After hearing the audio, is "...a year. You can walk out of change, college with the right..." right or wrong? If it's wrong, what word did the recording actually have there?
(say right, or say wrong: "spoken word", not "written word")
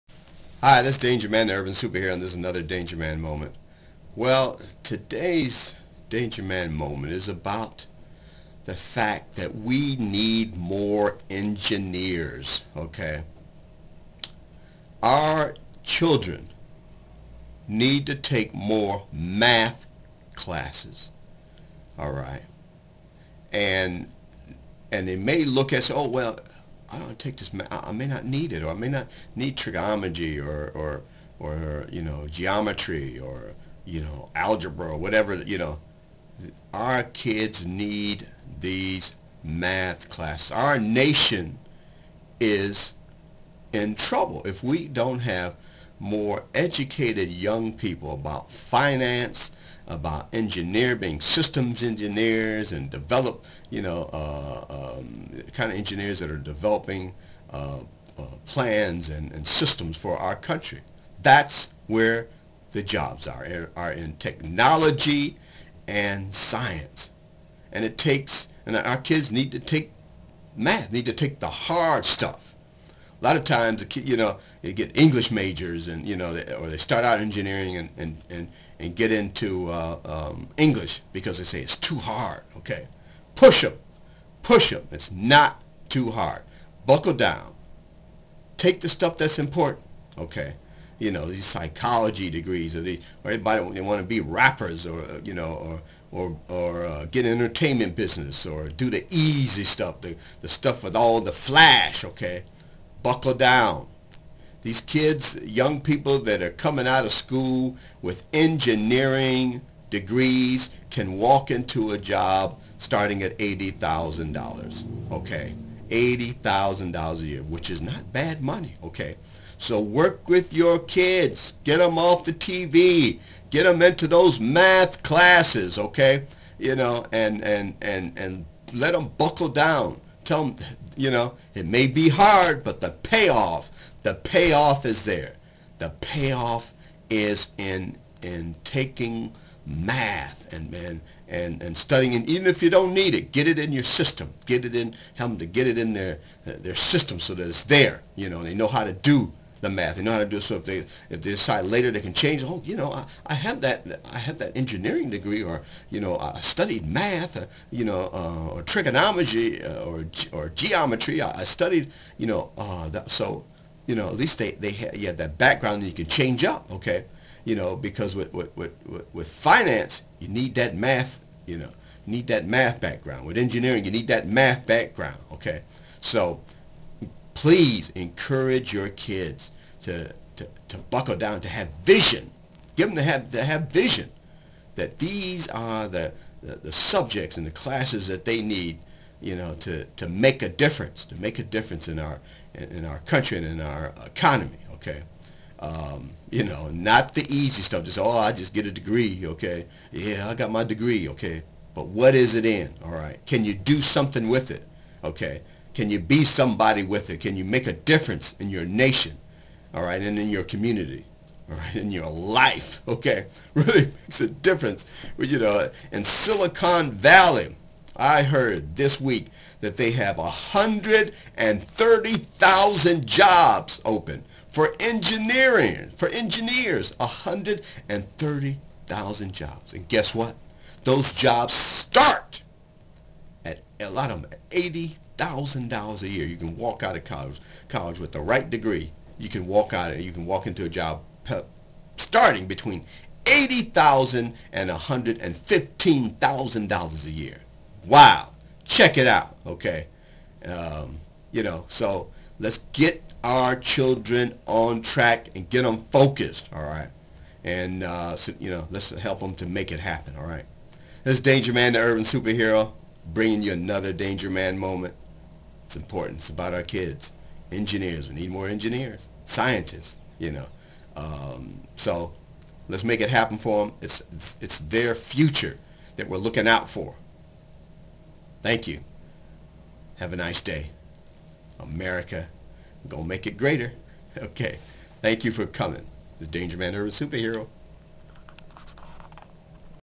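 wrong: "college", not "change".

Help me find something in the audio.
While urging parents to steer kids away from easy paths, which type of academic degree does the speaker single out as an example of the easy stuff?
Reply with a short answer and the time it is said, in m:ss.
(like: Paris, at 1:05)
Psychology, at 1:31.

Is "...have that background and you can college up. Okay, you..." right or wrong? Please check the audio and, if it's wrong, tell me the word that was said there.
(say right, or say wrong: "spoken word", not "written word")
wrong: "change", not "college".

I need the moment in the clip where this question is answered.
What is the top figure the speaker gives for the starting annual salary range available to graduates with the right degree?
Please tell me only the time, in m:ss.
4:04.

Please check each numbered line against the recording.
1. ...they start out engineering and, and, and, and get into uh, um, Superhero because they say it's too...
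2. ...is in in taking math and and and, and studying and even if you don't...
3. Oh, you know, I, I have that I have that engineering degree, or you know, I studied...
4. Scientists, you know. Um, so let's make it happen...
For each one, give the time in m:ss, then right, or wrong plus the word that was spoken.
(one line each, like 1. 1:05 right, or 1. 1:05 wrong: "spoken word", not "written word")
1. 1:16 wrong: "English", not "Superhero"
2. 2:17 right
3. 2:32 right
4. 4:29 right.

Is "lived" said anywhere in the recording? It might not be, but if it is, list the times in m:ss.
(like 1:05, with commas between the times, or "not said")
not said.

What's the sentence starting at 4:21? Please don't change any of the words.
This Danger Man, the urban superhero, bringing you another Danger Man moment.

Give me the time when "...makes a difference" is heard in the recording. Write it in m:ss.
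3:33.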